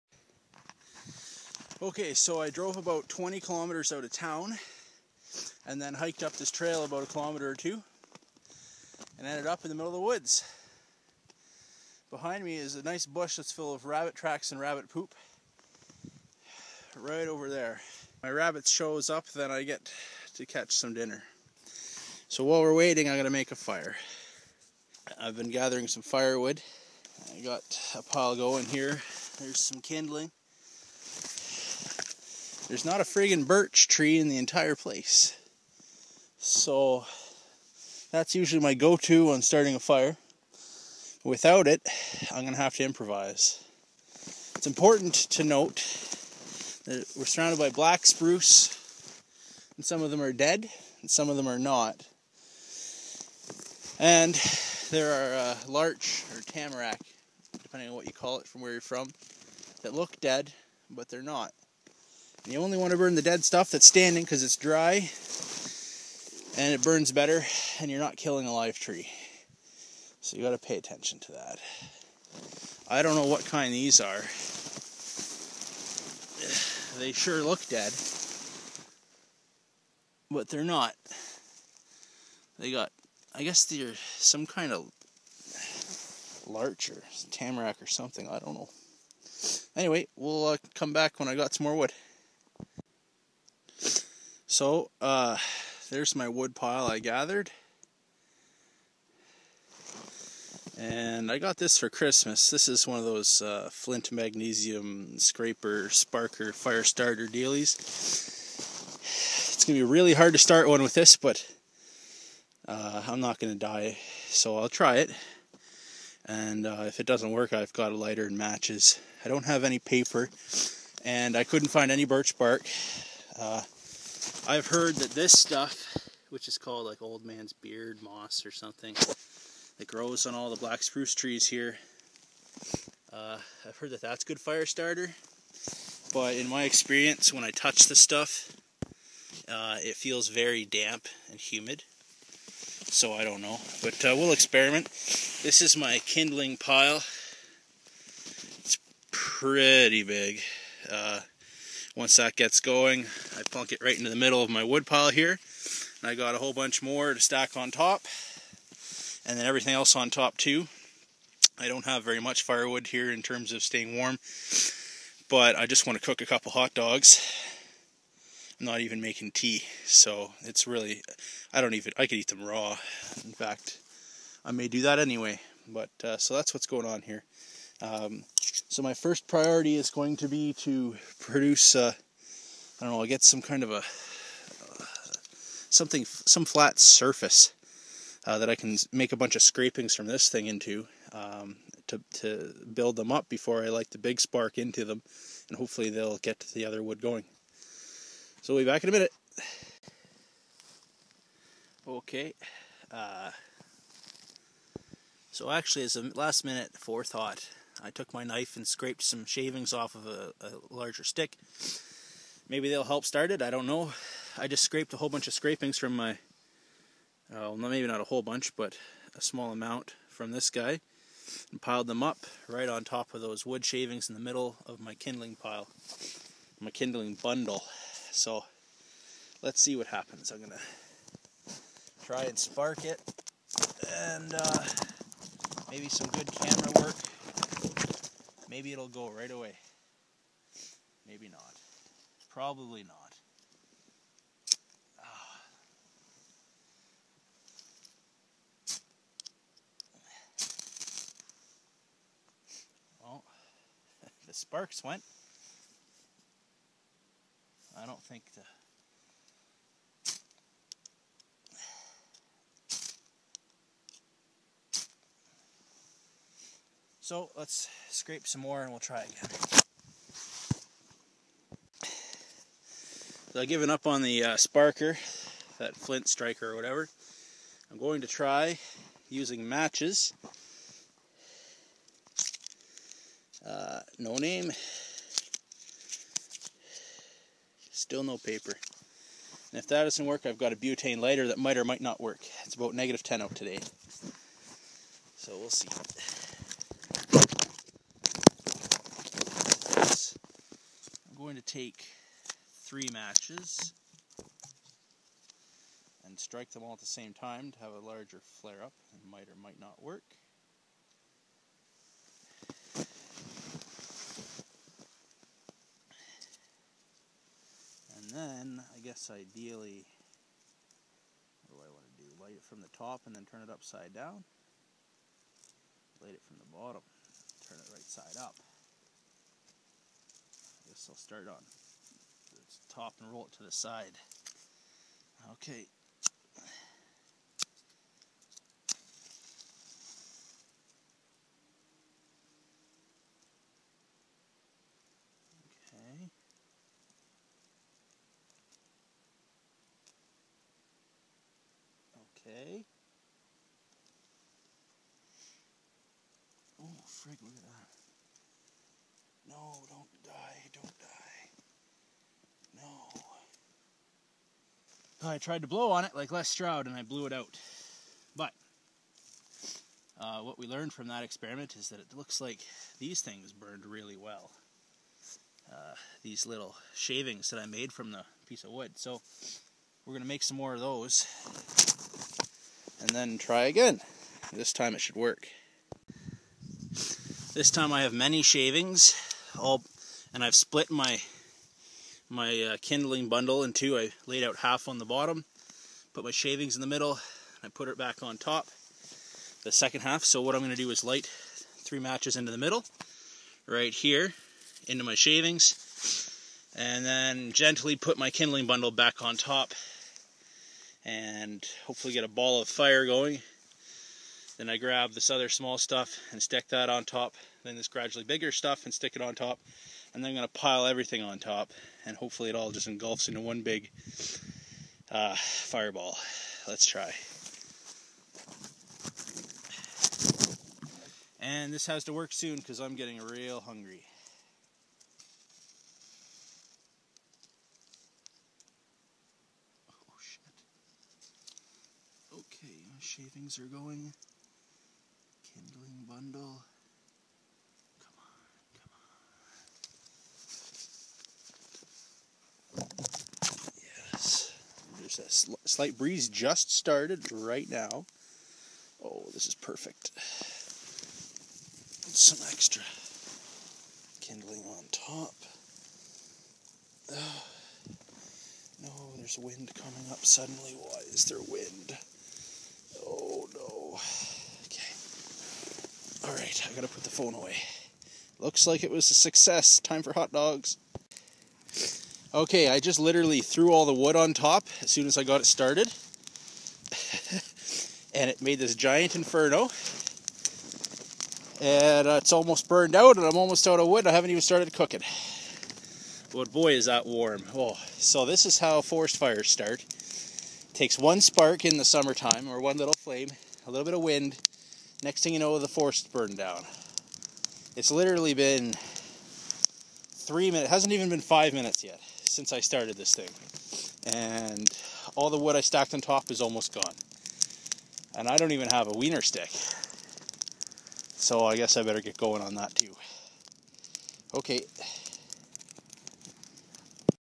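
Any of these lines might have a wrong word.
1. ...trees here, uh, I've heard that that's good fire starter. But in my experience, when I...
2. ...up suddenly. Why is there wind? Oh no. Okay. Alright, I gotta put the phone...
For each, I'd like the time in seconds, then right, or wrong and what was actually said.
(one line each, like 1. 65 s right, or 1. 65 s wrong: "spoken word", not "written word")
1. 131 s right
2. 469 s right.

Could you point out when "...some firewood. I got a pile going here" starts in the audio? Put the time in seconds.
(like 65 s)
25 s.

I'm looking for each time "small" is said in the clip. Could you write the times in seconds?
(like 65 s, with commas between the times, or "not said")
219 s, 415 s.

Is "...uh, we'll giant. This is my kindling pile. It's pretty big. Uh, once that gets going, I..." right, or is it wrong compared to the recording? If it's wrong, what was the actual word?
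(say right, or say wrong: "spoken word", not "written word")
wrong: "experiment", not "giant".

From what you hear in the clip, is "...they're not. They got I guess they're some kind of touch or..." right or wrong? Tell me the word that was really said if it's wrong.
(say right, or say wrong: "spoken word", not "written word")
wrong: "larch", not "touch".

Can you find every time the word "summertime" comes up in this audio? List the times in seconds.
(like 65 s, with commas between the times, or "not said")
501 s.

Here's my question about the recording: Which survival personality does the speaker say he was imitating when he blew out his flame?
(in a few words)
Les Stroud.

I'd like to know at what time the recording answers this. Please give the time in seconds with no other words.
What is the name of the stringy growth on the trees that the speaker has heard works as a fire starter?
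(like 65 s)
127 s.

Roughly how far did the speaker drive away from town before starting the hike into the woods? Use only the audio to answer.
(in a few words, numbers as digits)
20 kilometers.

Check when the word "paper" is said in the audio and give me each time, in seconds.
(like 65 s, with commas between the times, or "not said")
119 s, 288 s.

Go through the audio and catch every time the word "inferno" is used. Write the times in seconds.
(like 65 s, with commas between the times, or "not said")
488 s.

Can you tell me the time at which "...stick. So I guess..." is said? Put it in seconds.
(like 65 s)
519 s.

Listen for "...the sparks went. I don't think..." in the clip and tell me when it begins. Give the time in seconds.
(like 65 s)
254 s.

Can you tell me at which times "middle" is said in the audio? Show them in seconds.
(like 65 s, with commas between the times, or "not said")
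9 s, 154 s, 224 s, 396 s, 402 s.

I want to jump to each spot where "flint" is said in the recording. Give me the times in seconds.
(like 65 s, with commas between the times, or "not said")
103 s, 275 s.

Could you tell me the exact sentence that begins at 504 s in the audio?
Next thing you know, the forest burned down.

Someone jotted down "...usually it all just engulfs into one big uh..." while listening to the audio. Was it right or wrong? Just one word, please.
wrong.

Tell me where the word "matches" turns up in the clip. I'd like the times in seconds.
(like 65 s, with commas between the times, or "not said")
118 s, 279 s, 302 s, 401 s.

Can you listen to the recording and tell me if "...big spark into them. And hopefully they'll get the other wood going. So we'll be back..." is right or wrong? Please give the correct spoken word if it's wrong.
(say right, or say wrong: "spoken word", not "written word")
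right.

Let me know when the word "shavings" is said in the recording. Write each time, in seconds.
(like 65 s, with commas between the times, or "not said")
209 s, 223 s, 376 s, 388 s, 396 s, 404 s, 442 s.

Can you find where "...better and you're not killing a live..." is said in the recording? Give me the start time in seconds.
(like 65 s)
67 s.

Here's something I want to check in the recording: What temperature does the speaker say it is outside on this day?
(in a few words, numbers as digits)
-10.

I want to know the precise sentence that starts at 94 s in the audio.
So, uh, there's my wood pile I gathered.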